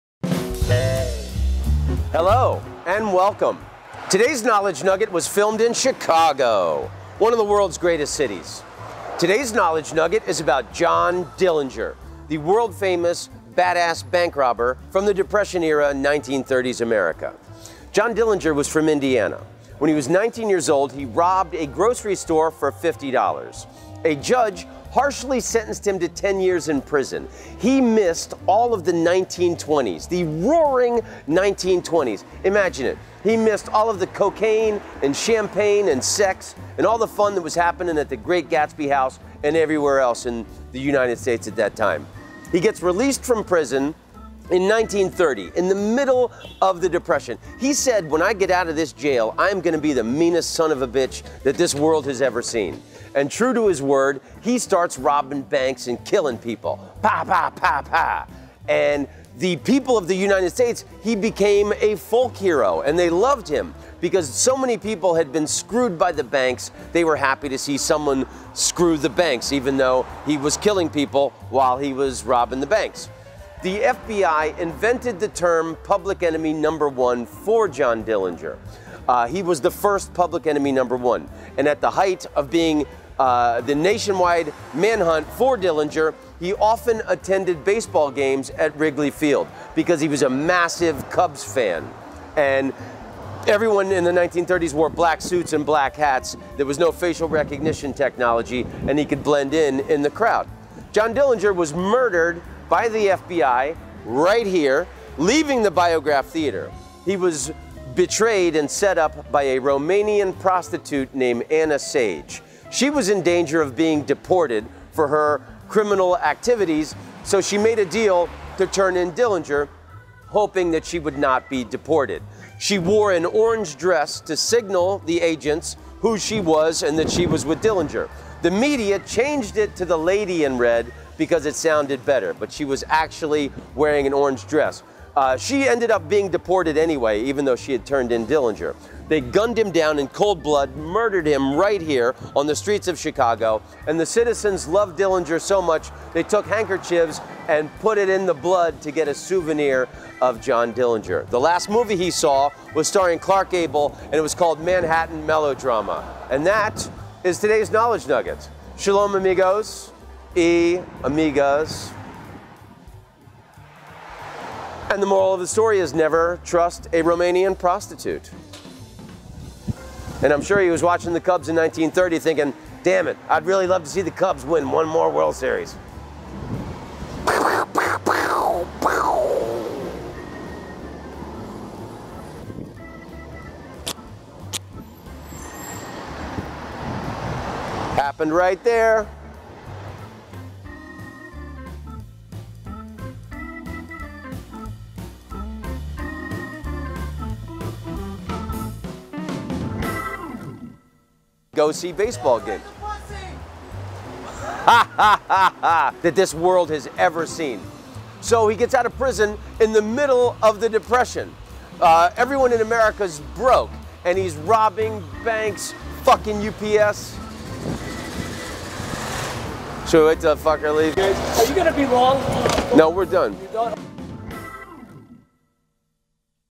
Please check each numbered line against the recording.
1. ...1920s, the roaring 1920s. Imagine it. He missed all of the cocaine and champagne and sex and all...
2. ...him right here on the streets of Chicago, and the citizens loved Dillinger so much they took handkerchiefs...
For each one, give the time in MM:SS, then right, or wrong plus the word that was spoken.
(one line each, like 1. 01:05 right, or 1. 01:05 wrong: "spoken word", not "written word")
1. 00:28 right
2. 02:21 right.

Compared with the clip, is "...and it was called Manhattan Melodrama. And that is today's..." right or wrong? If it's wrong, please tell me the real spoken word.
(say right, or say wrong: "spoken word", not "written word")
right.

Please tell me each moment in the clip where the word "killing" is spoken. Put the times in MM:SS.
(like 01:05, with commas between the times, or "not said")
00:56, 01:10.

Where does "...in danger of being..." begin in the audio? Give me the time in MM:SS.
01:53.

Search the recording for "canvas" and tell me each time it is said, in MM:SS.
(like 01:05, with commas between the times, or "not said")
not said.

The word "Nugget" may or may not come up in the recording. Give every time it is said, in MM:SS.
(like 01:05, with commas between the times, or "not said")
00:04, 00:09, 02:38.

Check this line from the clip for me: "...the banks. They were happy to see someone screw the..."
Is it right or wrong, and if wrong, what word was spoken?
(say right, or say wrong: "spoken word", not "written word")
right.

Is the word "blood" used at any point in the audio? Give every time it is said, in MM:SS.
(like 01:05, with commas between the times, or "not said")
02:20, 02:28.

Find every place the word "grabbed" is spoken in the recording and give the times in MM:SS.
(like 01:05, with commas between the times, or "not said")
not said.